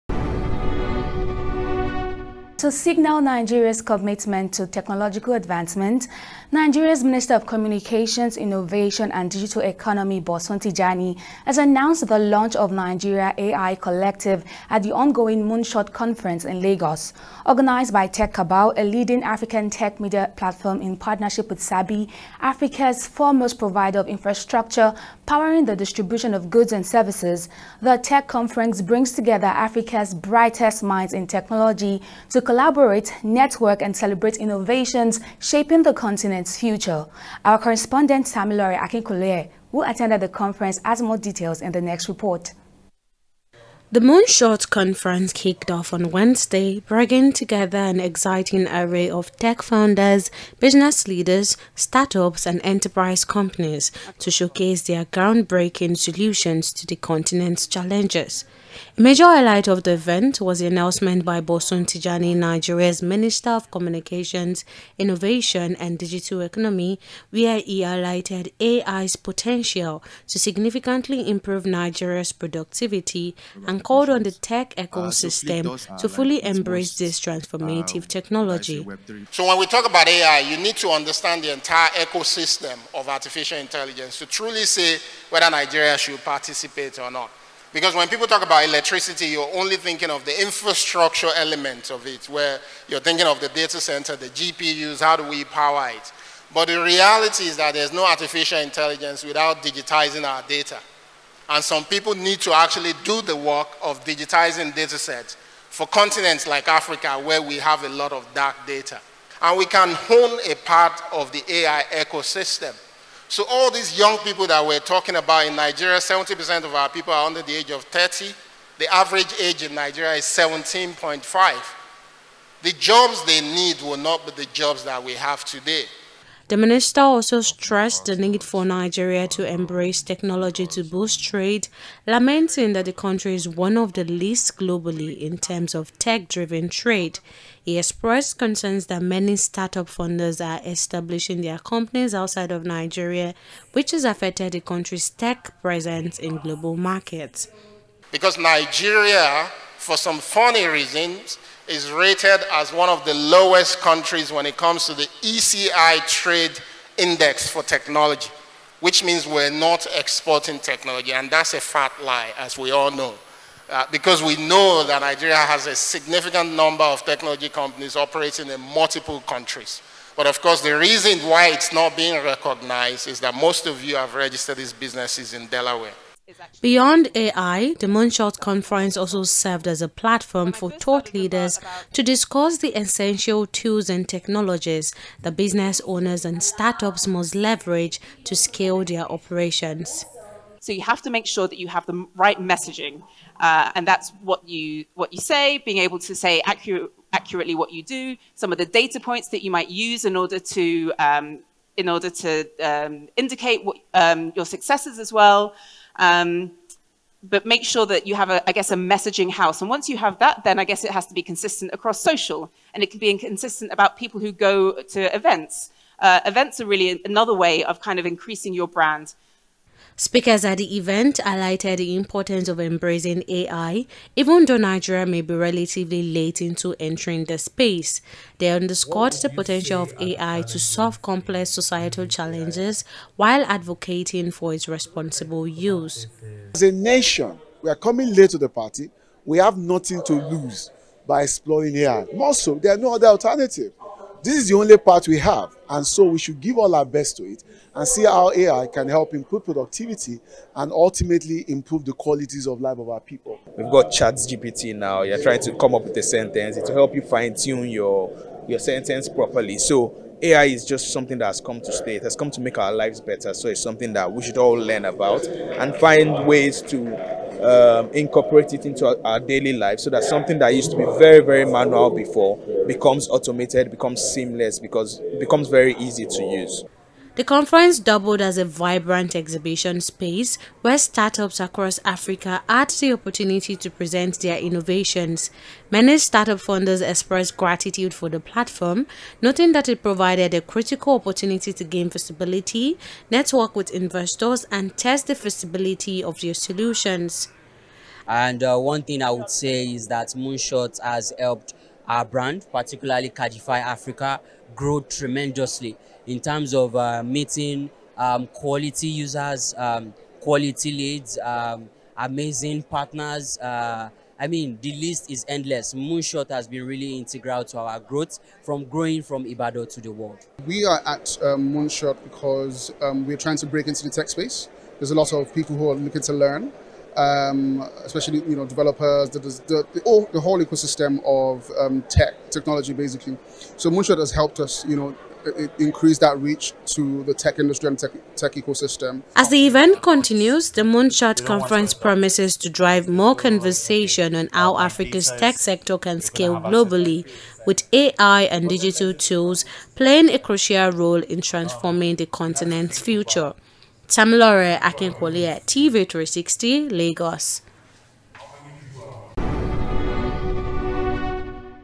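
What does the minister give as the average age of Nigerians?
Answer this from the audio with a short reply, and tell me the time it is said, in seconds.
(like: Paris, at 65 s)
17.5, at 120 s.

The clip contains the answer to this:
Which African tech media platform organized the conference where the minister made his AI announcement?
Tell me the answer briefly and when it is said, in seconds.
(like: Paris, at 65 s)
TechCabal, at 18 s.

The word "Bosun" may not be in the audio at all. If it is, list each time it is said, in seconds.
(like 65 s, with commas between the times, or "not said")
10 s, 61 s.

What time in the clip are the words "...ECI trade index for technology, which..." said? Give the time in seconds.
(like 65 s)
155 s.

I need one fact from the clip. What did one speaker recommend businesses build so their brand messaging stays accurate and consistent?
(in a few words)
A messaging house.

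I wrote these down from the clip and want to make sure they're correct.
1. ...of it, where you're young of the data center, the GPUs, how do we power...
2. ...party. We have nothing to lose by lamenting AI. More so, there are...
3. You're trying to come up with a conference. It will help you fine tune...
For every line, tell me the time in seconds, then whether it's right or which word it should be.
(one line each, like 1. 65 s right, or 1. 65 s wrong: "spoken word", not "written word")
1. 91 s wrong: "thinking", not "young"
2. 238 s wrong: "exploring", not "lamenting"
3. 255 s wrong: "sentence", not "conference".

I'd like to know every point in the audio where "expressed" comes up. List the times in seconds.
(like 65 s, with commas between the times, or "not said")
137 s, 286 s.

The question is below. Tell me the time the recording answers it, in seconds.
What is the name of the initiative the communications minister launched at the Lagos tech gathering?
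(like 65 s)
12 s.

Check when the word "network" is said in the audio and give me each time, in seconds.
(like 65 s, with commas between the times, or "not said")
33 s, 293 s.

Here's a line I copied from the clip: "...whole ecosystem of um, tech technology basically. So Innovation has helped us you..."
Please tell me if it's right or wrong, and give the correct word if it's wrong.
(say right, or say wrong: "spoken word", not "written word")
wrong: "Moonshot", not "Innovation".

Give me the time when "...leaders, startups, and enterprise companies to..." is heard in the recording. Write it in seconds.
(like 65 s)
51 s.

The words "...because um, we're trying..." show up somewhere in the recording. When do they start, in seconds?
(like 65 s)
322 s.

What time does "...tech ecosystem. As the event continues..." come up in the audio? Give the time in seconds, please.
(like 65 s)
338 s.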